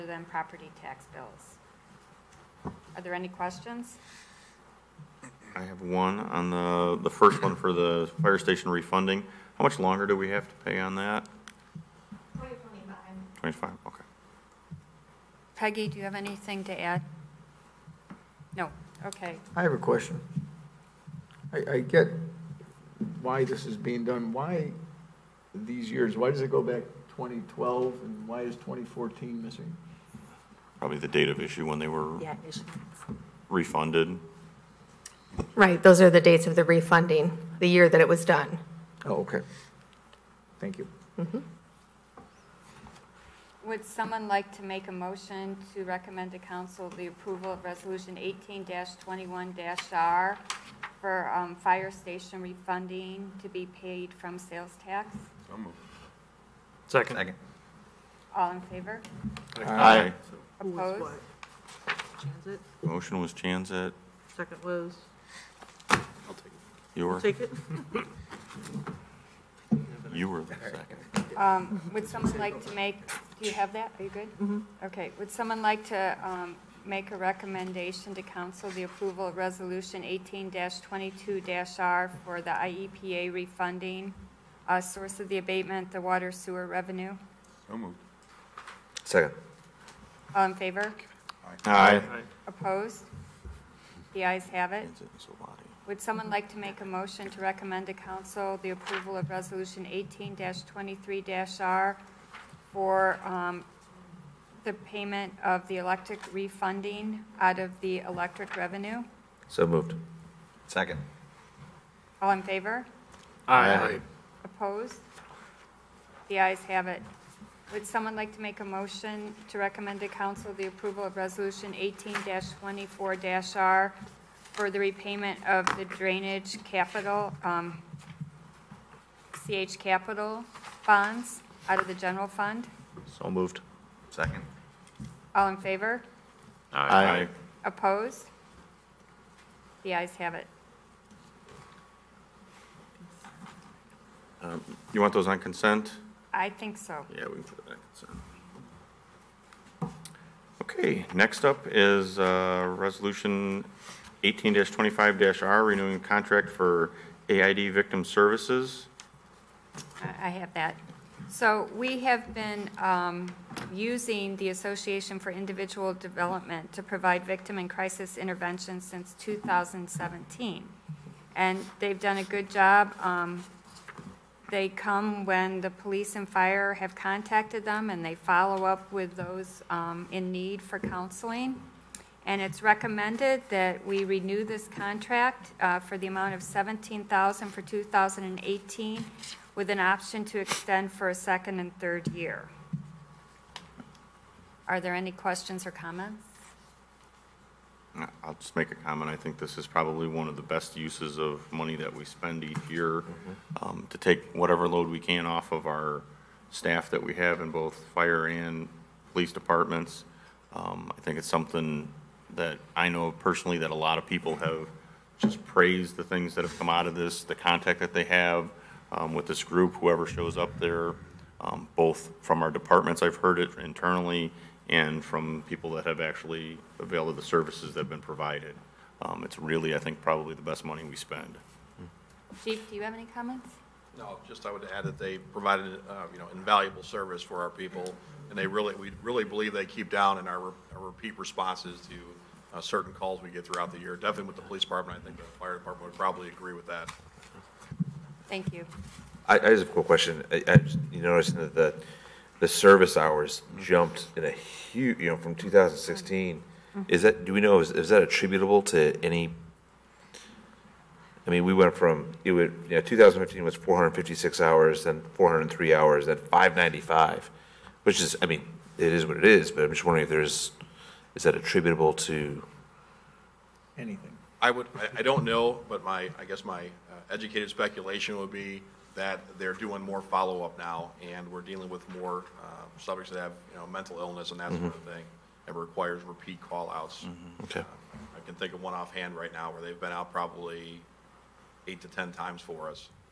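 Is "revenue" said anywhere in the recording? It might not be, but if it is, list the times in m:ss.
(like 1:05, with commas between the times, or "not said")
1:26, 1:48.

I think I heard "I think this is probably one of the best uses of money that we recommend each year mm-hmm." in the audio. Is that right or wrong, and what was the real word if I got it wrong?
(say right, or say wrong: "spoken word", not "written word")
wrong: "spend", not "recommend".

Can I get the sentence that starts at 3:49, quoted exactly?
Um, it's really, I think, probably the best money we spend.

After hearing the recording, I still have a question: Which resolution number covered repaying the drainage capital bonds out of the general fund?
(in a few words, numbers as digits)
18-24-R.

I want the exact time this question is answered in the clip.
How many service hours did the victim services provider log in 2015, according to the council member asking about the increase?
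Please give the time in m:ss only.
4:23.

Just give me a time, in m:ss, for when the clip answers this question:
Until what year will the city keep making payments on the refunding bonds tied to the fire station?
0:12.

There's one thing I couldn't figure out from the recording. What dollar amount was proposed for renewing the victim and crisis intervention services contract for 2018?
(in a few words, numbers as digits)
$17,000.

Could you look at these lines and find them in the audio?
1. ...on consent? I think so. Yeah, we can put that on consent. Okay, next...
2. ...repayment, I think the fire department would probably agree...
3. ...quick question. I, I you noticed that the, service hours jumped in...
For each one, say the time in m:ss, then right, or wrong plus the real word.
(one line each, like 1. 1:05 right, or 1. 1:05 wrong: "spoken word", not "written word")
1. 2:25 right
2. 4:04 wrong: "department", not "repayment"
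3. 4:09 right.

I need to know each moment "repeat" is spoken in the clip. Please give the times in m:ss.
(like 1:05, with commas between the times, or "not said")
4:00, 4:46.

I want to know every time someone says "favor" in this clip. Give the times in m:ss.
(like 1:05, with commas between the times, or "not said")
0:58, 1:30, 1:52, 2:15.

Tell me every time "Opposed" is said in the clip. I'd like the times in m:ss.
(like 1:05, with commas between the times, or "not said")
1:00, 1:32, 1:54, 2:17.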